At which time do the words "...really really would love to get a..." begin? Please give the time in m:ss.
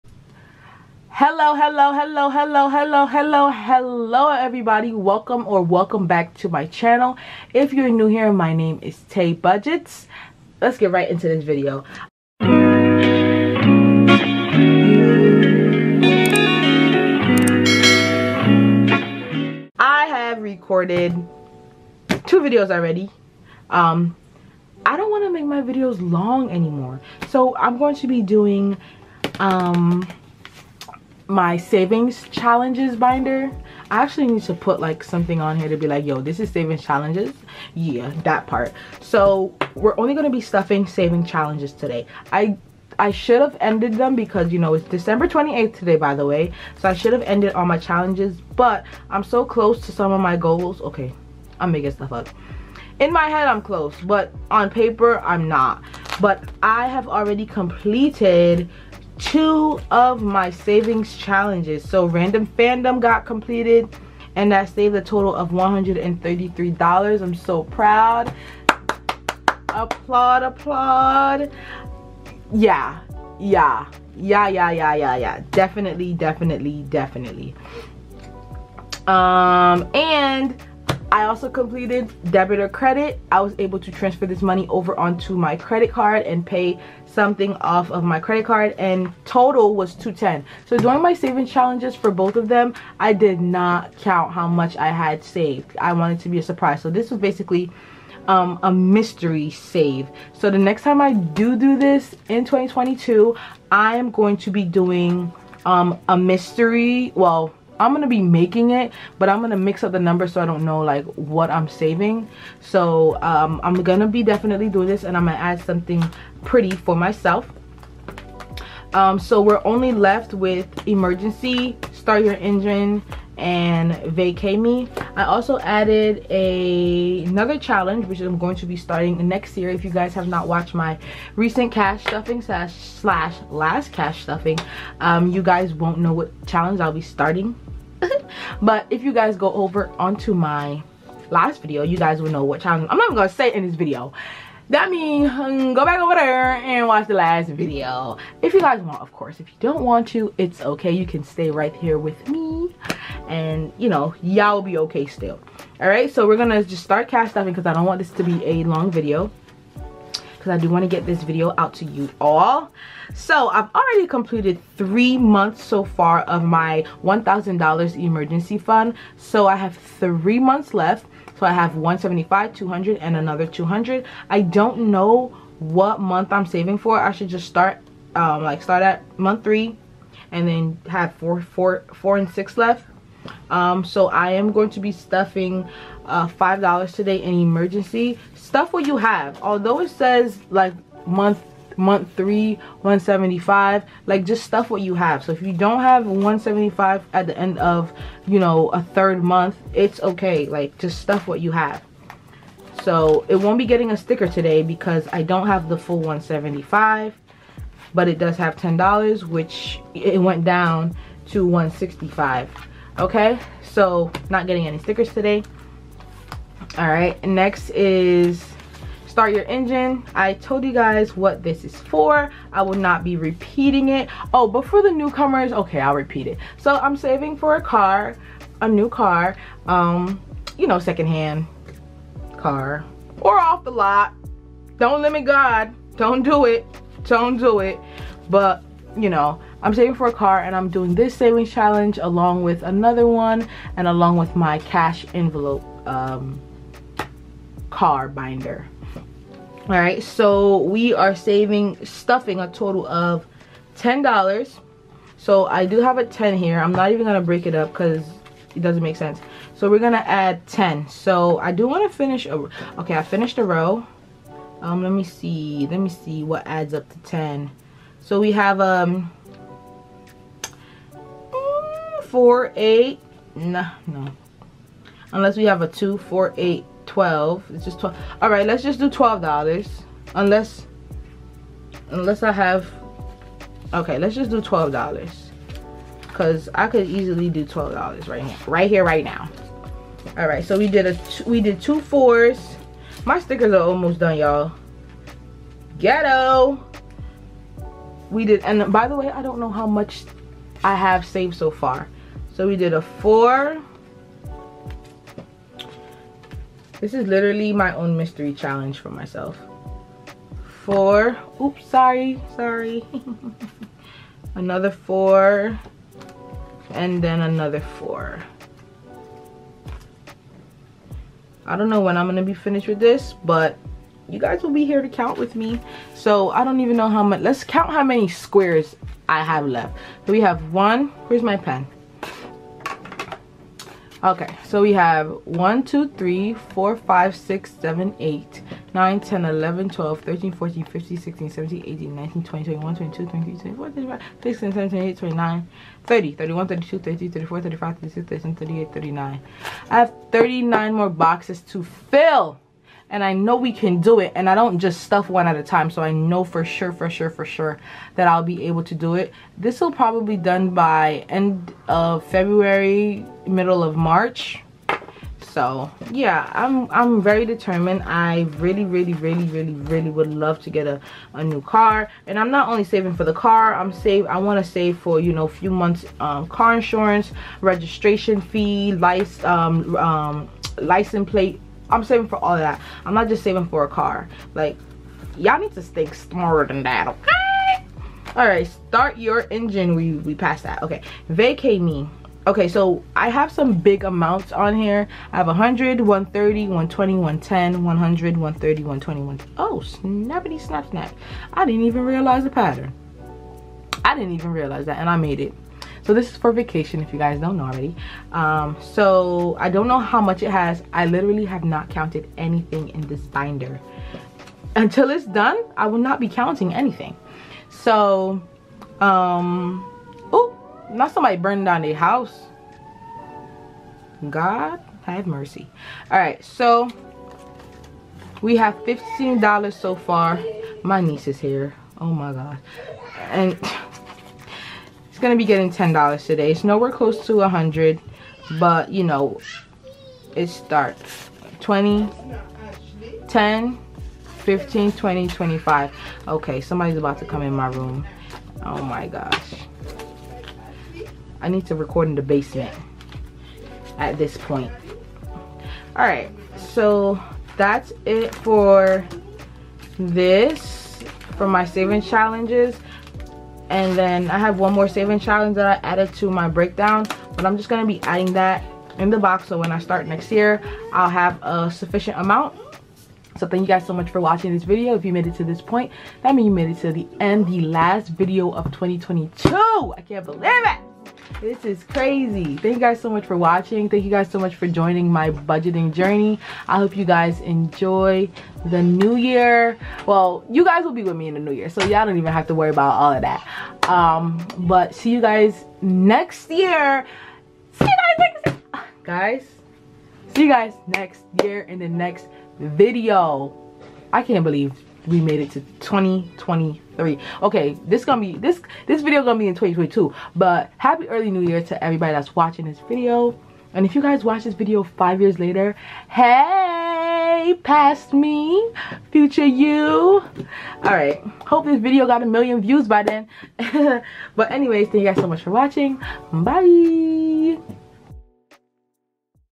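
6:09.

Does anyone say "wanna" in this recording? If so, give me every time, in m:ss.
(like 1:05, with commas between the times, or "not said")
4:21.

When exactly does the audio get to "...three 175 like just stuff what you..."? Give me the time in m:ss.
3:12.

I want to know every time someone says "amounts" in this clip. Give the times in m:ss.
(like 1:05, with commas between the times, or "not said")
6:33, 7:51.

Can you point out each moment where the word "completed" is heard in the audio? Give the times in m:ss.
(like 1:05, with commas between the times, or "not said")
0:57, 1:03, 1:21, 2:44.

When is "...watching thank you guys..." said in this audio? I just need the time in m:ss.
8:03.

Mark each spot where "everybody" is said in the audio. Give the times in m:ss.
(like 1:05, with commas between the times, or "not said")
0:04, 8:31.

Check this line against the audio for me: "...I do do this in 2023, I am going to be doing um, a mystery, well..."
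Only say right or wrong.
wrong.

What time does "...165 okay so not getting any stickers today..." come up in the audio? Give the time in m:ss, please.
3:31.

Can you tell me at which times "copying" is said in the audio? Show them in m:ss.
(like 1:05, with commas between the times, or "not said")
not said.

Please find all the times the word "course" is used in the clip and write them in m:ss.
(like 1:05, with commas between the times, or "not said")
2:29.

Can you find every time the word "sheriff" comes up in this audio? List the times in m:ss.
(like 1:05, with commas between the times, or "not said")
not said.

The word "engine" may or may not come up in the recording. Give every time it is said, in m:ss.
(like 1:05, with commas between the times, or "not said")
2:02, 3:39, 6:29.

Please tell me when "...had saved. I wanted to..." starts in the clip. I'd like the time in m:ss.
1:34.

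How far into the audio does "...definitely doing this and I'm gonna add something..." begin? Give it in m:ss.
1:54.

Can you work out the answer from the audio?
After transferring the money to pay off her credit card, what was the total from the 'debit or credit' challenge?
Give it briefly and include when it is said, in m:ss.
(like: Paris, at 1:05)
$210, at 1:29.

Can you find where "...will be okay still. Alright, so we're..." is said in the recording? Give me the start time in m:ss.
2:34.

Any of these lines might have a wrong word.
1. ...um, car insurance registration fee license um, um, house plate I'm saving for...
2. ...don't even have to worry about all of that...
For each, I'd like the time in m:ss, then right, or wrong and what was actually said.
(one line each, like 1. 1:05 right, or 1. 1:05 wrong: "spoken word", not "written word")
1. 6:16 wrong: "license", not "house"
2. 8:11 right.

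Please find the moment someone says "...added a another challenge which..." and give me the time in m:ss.
2:05.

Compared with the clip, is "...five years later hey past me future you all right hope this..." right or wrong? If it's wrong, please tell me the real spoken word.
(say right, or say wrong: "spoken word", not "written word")
right.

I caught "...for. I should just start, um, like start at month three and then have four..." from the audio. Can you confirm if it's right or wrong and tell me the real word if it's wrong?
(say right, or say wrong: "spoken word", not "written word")
right.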